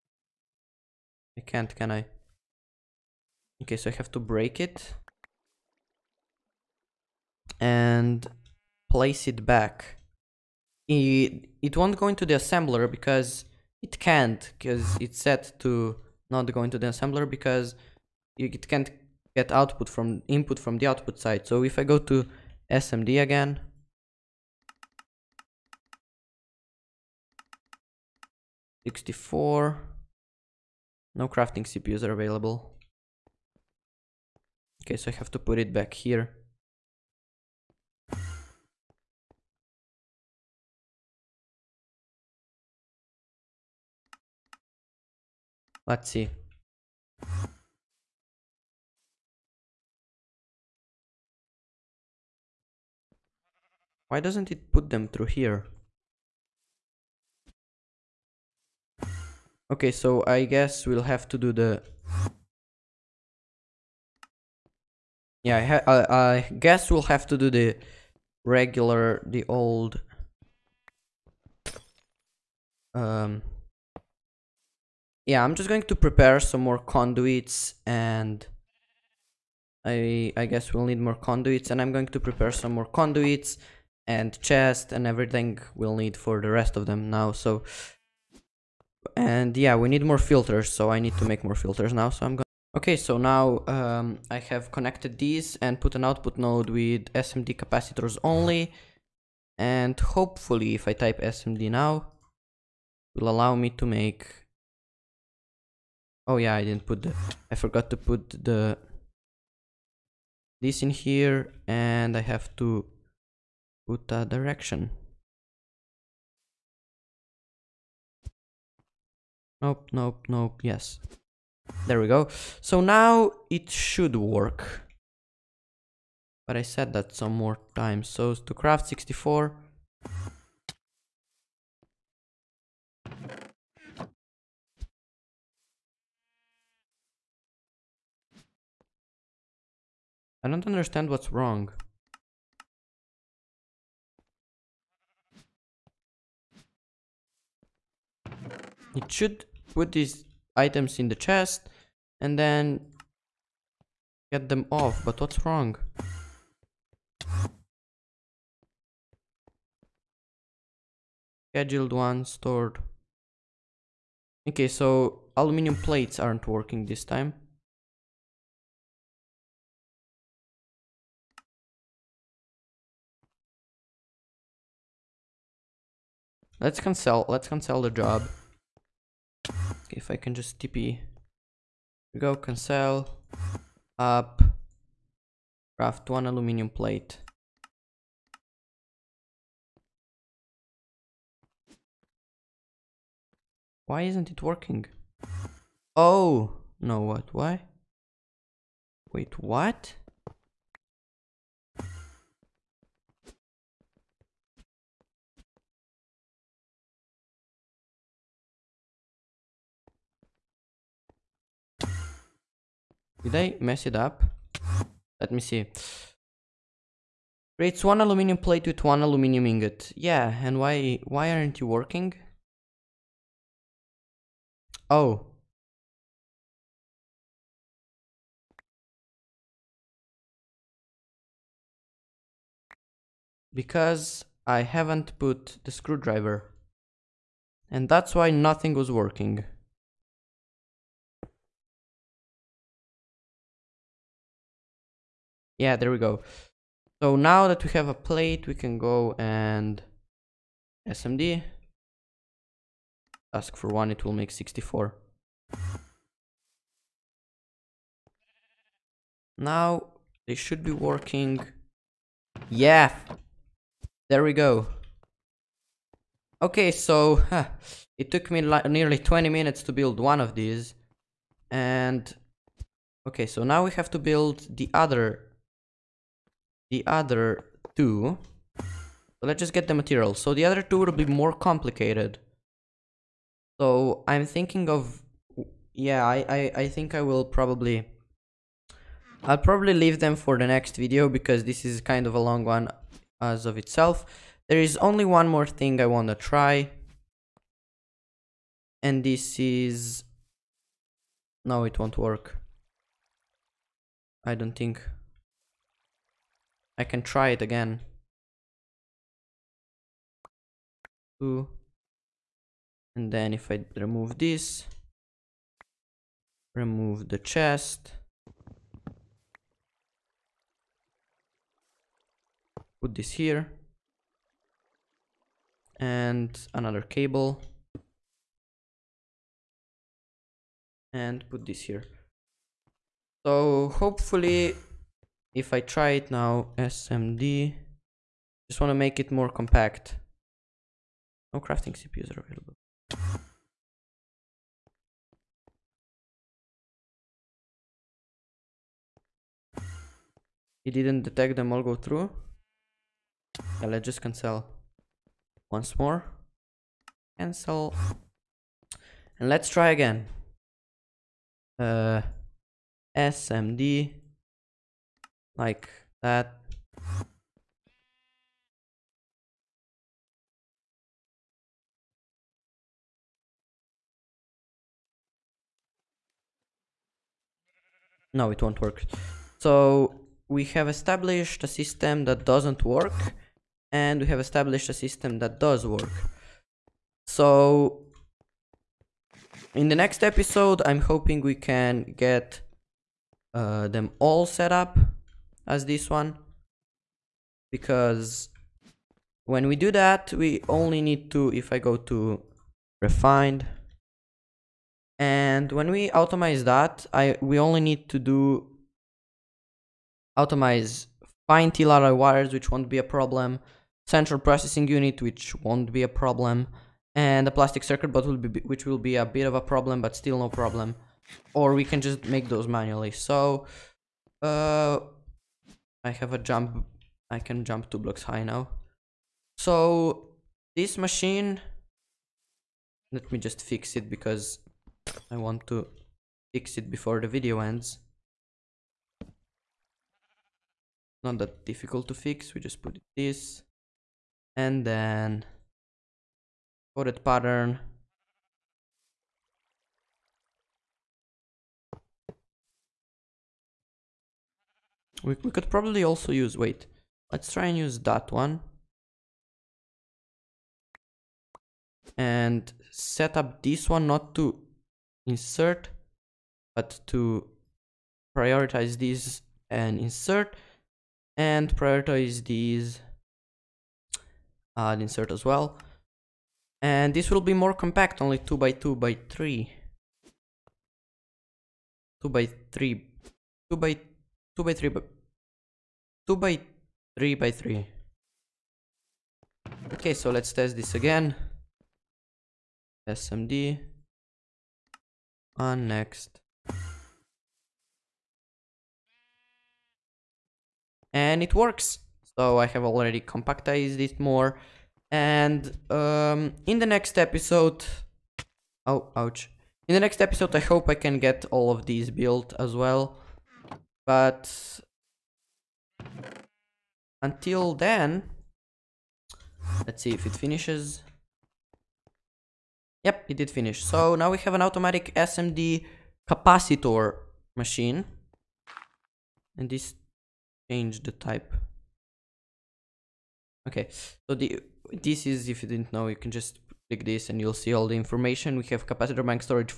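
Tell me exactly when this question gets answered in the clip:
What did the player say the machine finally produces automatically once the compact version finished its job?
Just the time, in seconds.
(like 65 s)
524 s.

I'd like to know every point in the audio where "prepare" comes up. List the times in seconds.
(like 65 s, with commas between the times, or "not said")
75 s, 82 s.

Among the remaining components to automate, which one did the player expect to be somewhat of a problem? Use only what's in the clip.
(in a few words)
plastic circuit board.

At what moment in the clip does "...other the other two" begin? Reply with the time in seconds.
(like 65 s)
274 s.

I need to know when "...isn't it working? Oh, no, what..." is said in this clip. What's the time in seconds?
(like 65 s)
194 s.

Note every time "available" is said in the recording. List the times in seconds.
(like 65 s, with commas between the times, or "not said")
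32 s, 342 s.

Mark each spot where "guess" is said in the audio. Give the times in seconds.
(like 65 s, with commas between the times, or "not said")
60 s, 66 s, 80 s.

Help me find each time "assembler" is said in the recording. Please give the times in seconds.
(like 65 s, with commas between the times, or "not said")
12 s, 16 s.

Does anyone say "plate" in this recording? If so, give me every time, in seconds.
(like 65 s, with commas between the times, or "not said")
165 s, 186 s, 218 s, 247 s.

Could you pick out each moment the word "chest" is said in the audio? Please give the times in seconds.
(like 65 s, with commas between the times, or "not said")
84 s, 151 s, 317 s.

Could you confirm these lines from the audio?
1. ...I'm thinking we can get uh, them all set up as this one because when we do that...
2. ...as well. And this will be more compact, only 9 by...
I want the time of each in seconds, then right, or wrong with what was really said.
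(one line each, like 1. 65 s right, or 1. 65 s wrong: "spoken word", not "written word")
1. 390 s wrong: "hoping", not "thinking"
2. 475 s wrong: "2", not "9".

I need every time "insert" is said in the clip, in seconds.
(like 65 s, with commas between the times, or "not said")
465 s, 469 s, 474 s.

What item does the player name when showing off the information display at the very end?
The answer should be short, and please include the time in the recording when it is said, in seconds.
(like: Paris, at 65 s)
capacitor bank, at 538 s.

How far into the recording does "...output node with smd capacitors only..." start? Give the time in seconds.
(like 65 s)
96 s.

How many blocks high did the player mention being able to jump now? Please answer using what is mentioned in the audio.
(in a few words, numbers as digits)
2.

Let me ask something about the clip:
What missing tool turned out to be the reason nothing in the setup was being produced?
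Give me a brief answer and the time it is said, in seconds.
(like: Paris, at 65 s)
screwdriver, at 235 s.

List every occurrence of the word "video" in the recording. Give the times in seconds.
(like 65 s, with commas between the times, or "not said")
290 s, 437 s.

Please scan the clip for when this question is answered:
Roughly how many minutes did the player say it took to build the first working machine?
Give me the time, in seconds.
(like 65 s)
268 s.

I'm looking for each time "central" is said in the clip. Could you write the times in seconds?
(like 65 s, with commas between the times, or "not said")
413 s.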